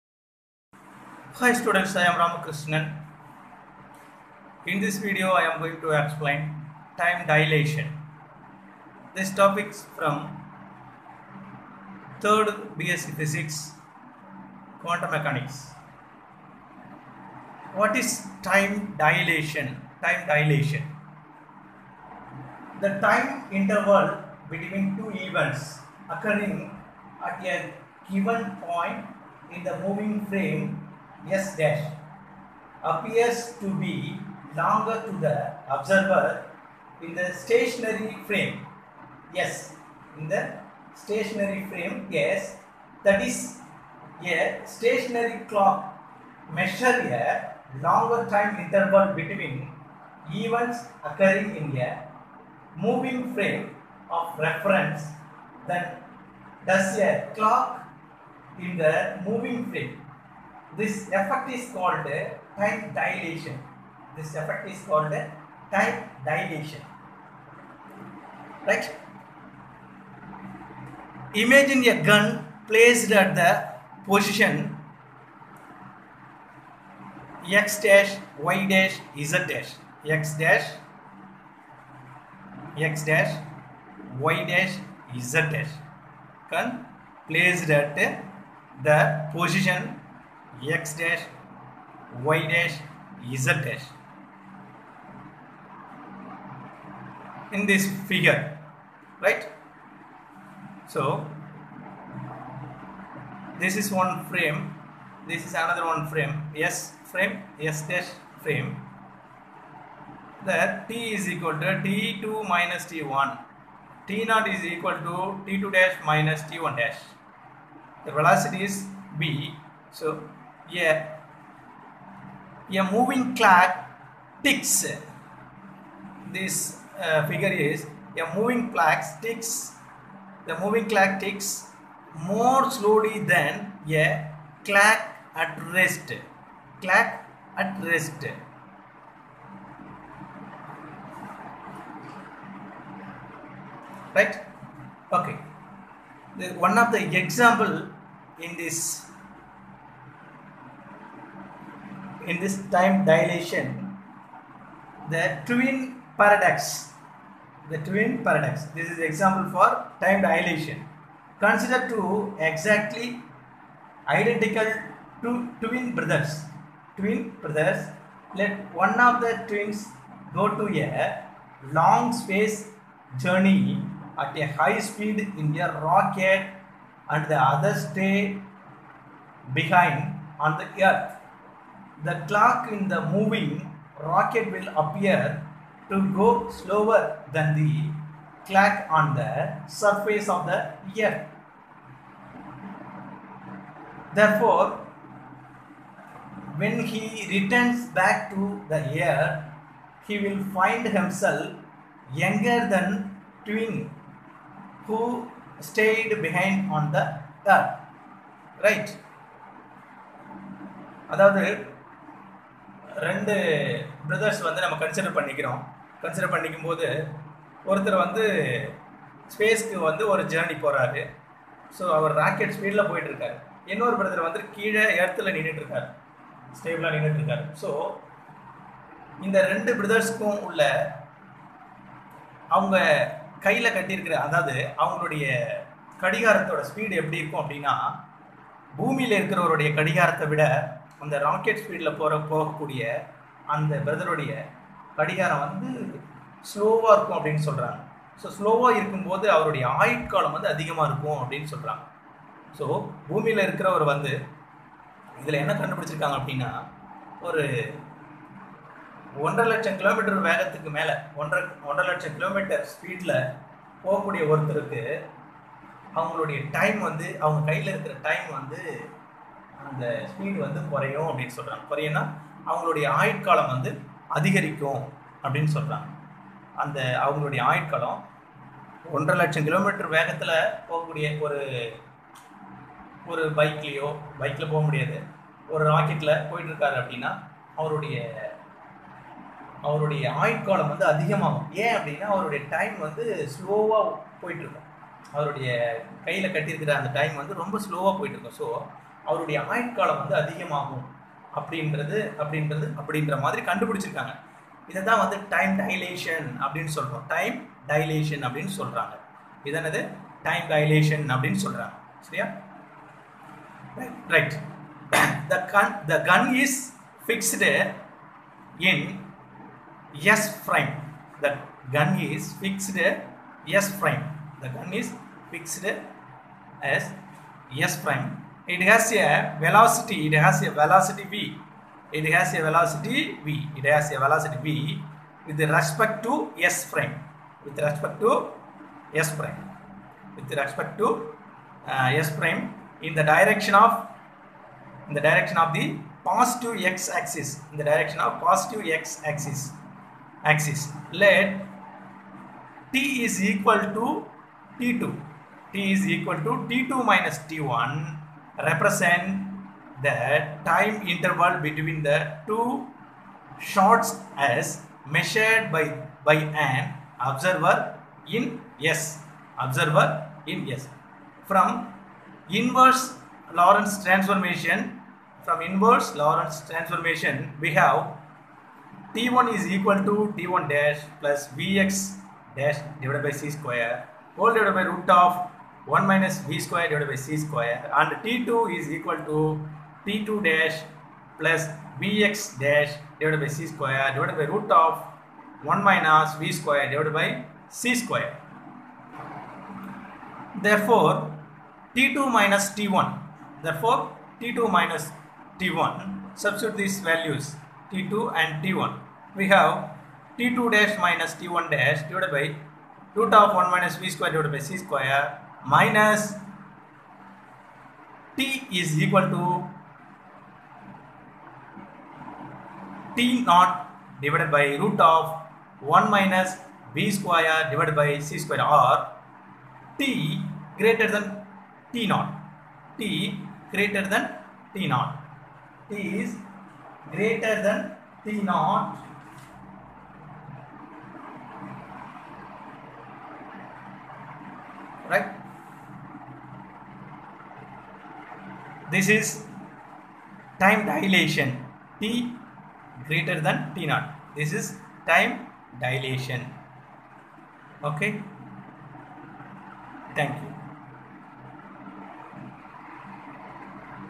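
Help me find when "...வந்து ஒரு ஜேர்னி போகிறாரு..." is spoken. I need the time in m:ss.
3:39.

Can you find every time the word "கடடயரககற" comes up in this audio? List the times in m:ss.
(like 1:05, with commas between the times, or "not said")
3:53, 4:56.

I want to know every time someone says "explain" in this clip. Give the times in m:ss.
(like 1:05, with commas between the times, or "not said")
0:05.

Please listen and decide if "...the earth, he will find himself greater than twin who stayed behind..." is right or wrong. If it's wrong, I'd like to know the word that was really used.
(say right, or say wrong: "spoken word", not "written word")
wrong: "younger", not "greater".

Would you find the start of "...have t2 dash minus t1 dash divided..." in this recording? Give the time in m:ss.
6:49.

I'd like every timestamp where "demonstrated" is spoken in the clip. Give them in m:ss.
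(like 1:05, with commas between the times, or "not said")
not said.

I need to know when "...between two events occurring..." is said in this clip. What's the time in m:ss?
0:24.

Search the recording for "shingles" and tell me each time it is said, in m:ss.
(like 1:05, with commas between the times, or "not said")
not said.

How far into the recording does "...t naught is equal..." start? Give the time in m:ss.
1:54.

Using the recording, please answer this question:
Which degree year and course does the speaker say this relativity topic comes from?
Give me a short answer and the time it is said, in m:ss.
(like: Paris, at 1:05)
3rd BSc Physics, at 0:12.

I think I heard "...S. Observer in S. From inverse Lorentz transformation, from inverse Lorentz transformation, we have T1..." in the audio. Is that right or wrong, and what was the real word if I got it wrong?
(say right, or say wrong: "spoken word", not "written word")
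right.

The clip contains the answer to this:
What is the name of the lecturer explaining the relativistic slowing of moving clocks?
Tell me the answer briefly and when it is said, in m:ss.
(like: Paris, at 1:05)
Ramakrishnan, at 0:02.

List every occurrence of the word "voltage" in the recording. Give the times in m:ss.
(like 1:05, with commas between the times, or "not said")
not said.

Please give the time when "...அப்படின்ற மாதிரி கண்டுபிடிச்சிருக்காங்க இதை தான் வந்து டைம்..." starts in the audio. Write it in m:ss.
5:02.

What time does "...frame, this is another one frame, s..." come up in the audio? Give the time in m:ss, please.
1:44.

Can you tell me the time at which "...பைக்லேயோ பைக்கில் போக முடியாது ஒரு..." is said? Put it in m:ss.
4:43.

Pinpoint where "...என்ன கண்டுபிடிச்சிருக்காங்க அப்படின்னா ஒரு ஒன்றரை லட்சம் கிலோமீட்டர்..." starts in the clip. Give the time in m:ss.
4:15.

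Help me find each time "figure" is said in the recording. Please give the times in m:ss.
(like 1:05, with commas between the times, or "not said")
1:38, 2:07.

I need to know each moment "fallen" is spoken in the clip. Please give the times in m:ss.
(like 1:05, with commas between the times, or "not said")
not said.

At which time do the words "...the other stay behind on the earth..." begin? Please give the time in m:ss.
2:57.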